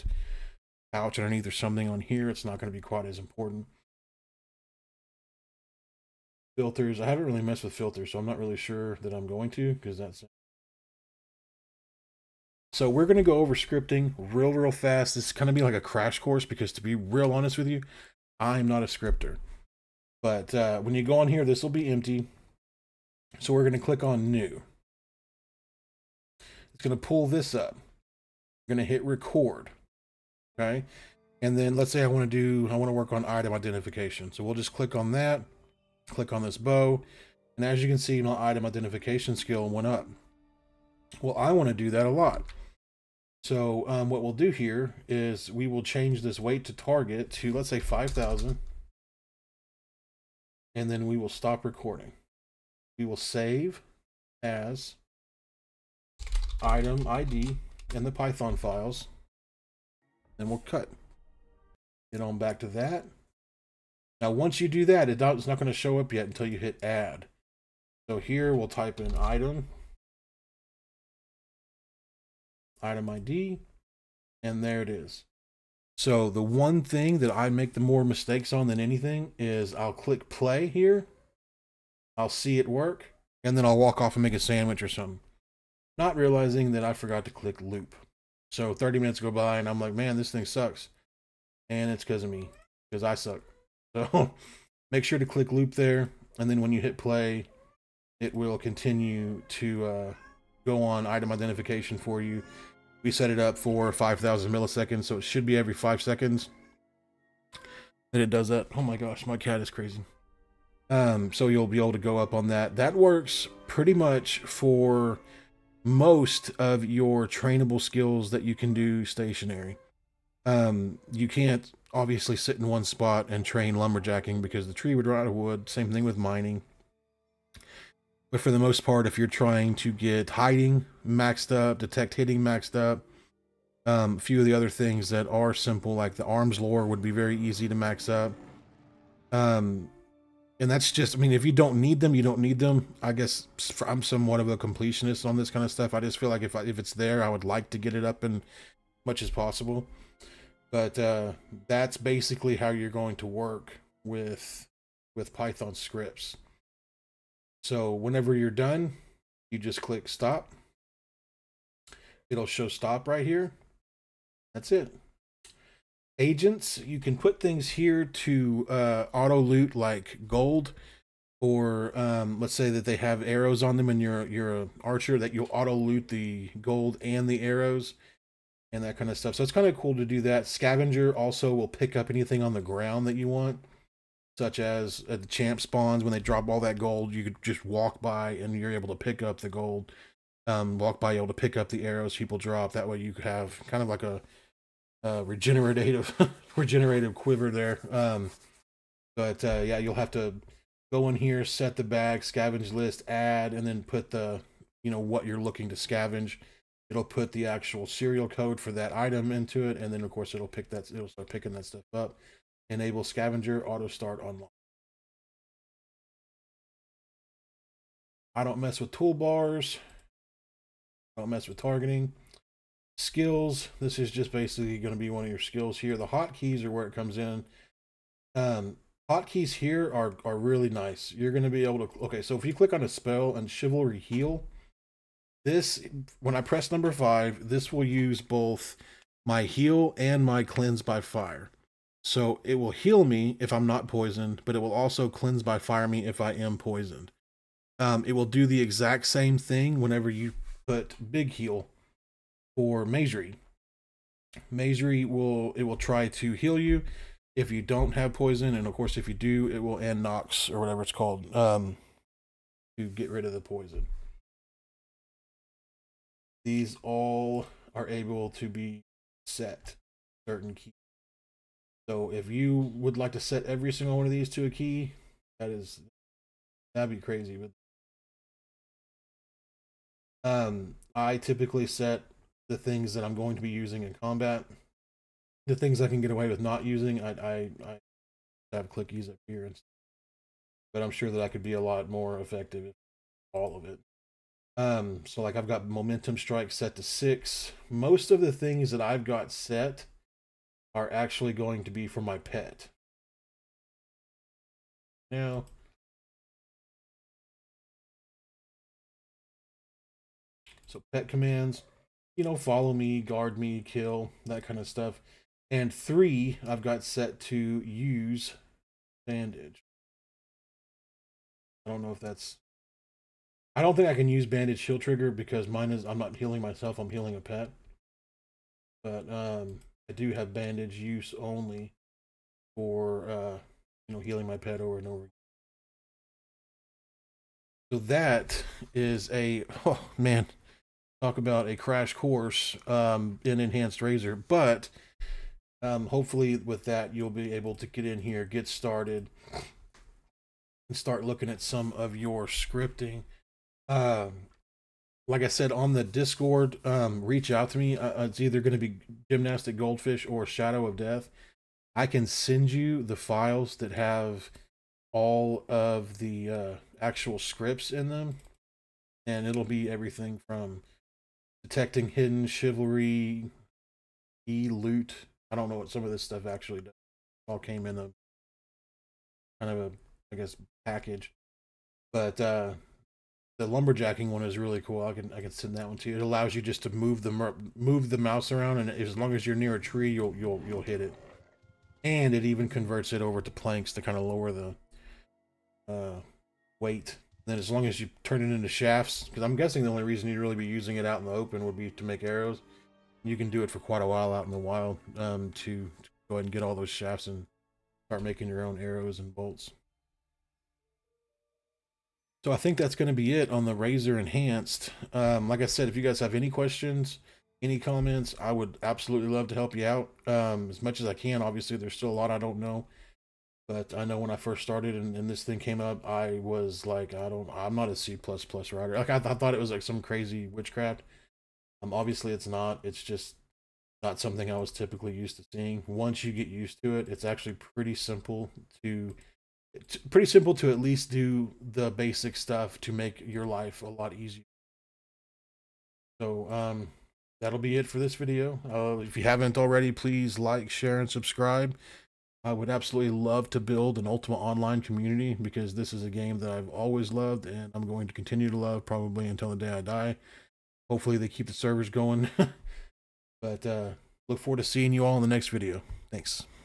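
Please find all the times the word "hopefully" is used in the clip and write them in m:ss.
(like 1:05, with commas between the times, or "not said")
5:45, 7:40.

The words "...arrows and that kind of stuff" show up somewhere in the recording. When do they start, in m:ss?
2:57.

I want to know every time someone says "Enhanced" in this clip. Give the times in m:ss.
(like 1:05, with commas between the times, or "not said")
5:43, 6:53.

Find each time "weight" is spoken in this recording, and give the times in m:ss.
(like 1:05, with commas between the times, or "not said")
0:46, 6:36.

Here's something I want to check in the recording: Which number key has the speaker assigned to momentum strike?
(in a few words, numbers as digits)
6.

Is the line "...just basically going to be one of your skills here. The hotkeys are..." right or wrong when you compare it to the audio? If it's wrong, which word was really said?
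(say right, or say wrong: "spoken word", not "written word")
right.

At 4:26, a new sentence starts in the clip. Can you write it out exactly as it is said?
These all are able to be set certain key.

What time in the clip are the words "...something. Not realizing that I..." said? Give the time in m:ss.
1:24.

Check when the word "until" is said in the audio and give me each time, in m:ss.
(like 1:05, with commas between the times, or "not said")
1:06, 7:39.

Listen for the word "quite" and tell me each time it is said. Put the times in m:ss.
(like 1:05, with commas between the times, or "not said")
0:02, 6:43.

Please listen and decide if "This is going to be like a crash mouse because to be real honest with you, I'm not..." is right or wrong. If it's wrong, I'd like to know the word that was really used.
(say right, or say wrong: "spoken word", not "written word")
wrong: "course", not "mouse".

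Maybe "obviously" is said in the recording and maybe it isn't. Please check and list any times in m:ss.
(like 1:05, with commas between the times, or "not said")
2:01, 7:01, 7:11.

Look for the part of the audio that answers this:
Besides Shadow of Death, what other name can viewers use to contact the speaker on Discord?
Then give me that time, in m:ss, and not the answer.
5:59.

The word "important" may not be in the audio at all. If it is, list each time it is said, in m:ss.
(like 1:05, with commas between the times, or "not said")
0:03.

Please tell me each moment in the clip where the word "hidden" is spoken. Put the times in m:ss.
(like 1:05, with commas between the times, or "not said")
2:12, 6:11.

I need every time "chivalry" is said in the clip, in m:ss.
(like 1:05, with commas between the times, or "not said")
3:53, 6:12.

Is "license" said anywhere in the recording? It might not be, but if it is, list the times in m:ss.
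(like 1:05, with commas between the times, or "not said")
not said.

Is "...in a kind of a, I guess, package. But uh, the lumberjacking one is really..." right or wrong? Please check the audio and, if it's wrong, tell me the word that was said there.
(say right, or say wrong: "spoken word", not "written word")
right.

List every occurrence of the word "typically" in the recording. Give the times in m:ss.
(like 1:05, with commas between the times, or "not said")
4:41, 7:14.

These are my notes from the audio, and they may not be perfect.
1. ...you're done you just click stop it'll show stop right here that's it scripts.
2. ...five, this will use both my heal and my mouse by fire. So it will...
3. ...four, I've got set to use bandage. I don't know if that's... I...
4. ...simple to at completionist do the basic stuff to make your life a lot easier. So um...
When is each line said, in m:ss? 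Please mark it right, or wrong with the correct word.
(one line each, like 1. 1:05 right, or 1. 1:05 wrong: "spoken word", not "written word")
1. 2:38 wrong: "agents", not "scripts"
2. 3:56 wrong: "cleanse", not "mouse"
3. 5:15 wrong: "three", not "four"
4. 7:20 wrong: "least", not "completionist".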